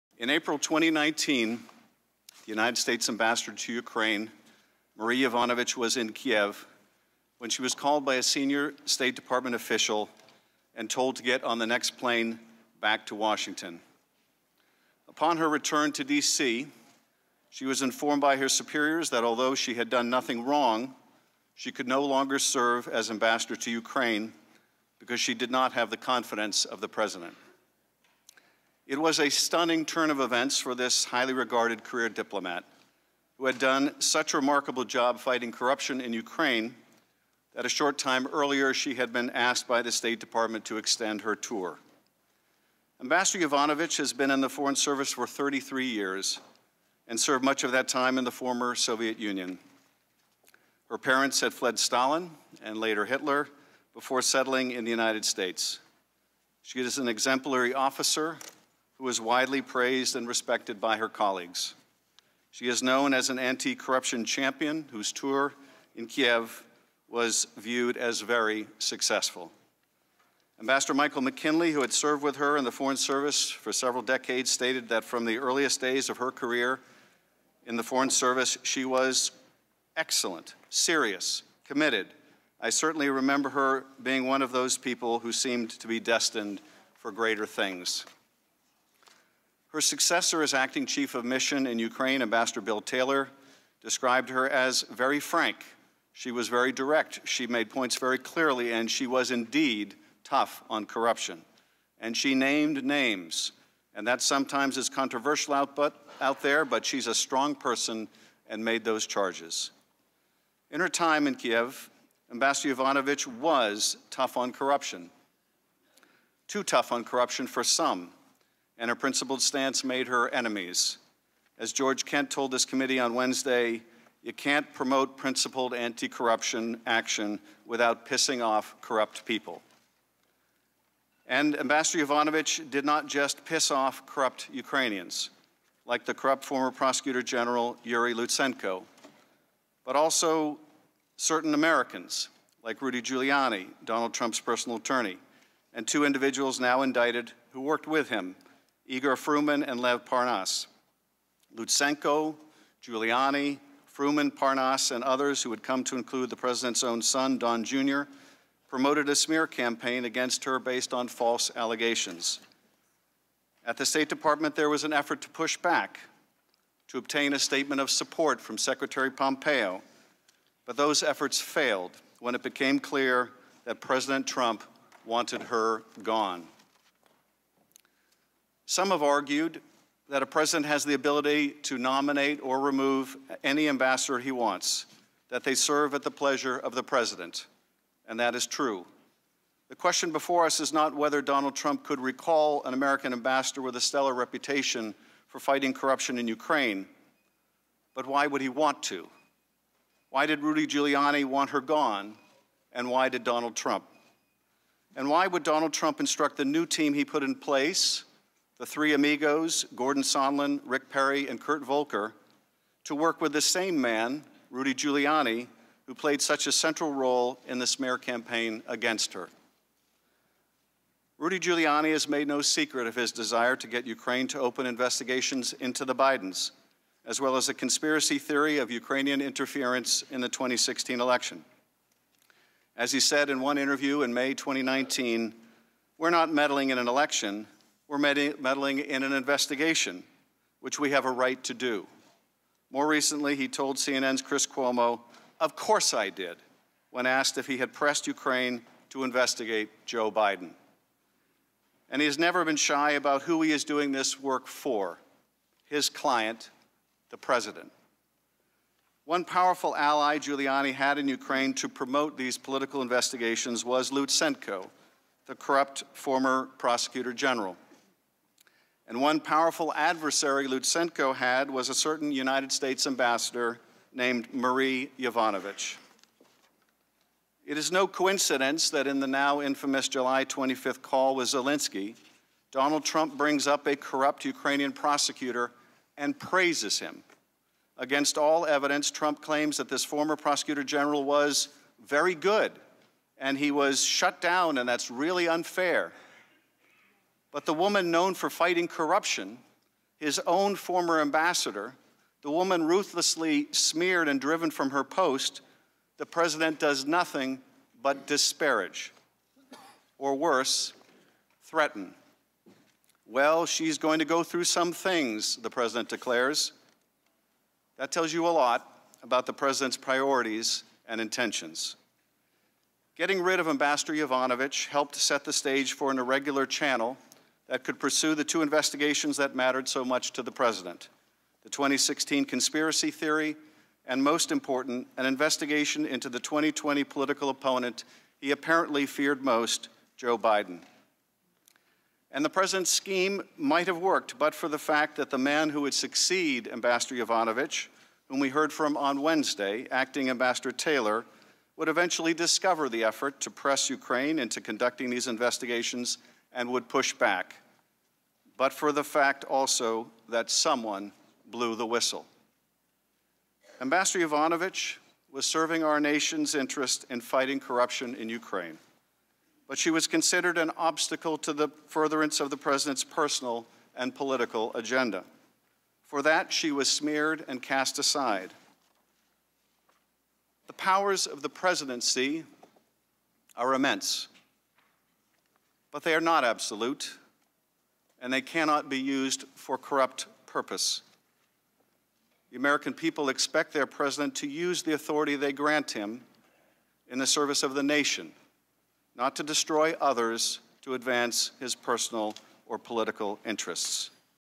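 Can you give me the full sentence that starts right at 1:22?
I certainly remember her being one of those people who seemed to be destined for greater things.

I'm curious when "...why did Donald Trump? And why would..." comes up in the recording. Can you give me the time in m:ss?
3:22.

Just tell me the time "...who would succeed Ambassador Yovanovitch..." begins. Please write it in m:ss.
5:45.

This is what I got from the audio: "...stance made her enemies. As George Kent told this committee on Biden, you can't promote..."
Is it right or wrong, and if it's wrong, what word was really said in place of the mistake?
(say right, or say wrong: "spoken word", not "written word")
wrong: "Wednesday", not "Biden".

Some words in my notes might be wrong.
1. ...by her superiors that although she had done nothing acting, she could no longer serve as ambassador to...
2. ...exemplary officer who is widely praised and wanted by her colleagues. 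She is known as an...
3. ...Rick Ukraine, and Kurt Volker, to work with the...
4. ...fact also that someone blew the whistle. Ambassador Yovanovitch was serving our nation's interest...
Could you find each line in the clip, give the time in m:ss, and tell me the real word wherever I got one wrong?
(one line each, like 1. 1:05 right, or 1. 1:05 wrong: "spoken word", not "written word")
1. 0:18 wrong: "wrong", not "acting"
2. 0:57 wrong: "respected", not "wanted"
3. 3:30 wrong: "Perry", not "Ukraine"
4. 5:58 right.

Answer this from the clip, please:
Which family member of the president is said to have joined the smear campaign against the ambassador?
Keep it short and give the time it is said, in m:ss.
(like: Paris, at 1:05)
Don Jr., at 2:37.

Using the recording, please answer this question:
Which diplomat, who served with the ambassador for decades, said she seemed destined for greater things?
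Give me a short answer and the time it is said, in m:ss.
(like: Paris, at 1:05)
Michael McKinley, at 1:10.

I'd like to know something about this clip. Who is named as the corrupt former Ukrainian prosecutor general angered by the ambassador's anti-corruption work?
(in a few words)
Yuri Lutsenko.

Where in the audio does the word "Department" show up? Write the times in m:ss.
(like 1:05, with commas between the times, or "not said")
0:09, 0:40, 2:44.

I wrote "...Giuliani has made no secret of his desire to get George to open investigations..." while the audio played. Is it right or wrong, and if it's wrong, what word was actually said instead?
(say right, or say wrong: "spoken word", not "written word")
wrong: "Ukraine", not "George".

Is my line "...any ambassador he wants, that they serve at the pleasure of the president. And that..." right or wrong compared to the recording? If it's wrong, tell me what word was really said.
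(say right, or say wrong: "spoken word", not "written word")
right.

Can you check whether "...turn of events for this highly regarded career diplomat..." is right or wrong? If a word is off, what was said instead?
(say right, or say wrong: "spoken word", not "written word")
right.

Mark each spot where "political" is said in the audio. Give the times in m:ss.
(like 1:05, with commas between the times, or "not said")
4:22, 5:36, 6:13, 6:42.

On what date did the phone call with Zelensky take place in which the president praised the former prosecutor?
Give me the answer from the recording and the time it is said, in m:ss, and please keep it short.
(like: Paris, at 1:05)
July 25th, at 4:39.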